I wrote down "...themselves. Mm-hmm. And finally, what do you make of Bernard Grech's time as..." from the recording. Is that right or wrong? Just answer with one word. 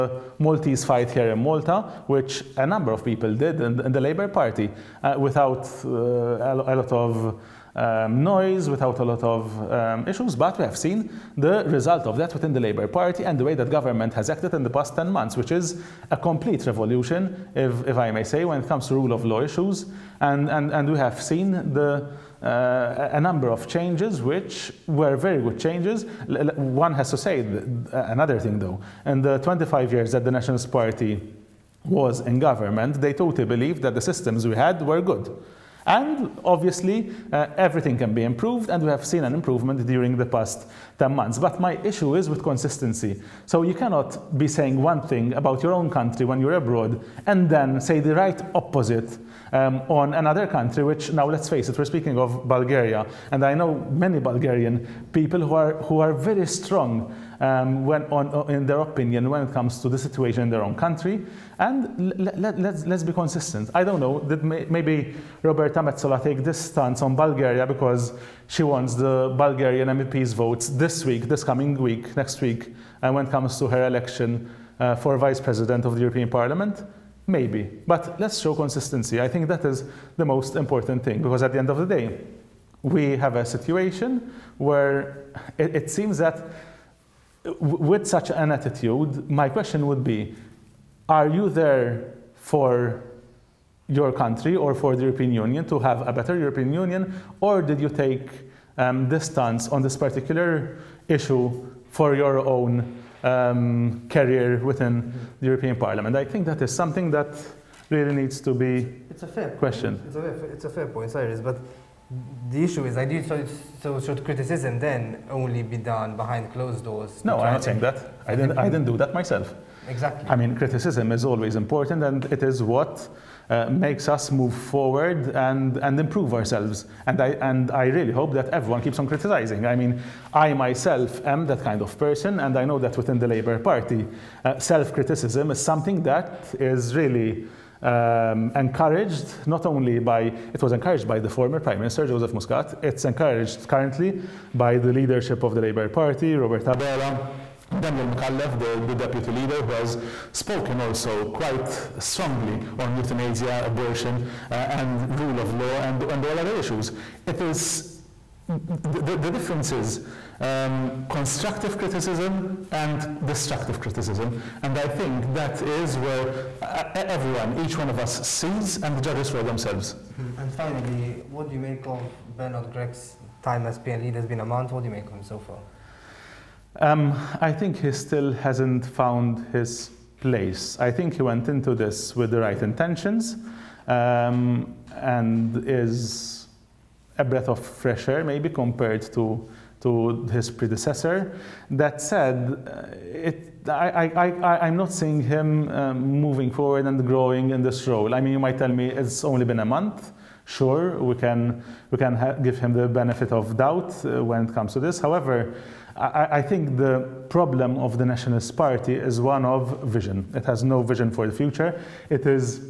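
right.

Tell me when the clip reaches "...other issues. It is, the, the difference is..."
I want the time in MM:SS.
02:36.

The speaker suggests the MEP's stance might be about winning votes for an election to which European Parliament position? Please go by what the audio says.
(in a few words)
Vice president.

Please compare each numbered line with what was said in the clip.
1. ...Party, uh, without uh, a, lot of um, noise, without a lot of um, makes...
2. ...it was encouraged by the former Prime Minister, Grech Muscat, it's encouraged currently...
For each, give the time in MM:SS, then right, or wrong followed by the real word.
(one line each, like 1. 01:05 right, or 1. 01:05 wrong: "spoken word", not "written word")
1. 00:04 wrong: "issues", not "makes"
2. 02:20 wrong: "Joseph", not "Grech".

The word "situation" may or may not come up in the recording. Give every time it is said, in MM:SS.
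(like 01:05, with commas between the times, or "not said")
00:59, 01:23.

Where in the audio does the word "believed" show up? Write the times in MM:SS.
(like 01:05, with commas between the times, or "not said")
00:33.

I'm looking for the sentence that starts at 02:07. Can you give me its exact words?
And I, and I really hope that everyone keeps on criticizing.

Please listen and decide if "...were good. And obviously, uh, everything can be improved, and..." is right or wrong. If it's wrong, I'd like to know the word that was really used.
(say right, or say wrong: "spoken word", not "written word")
right.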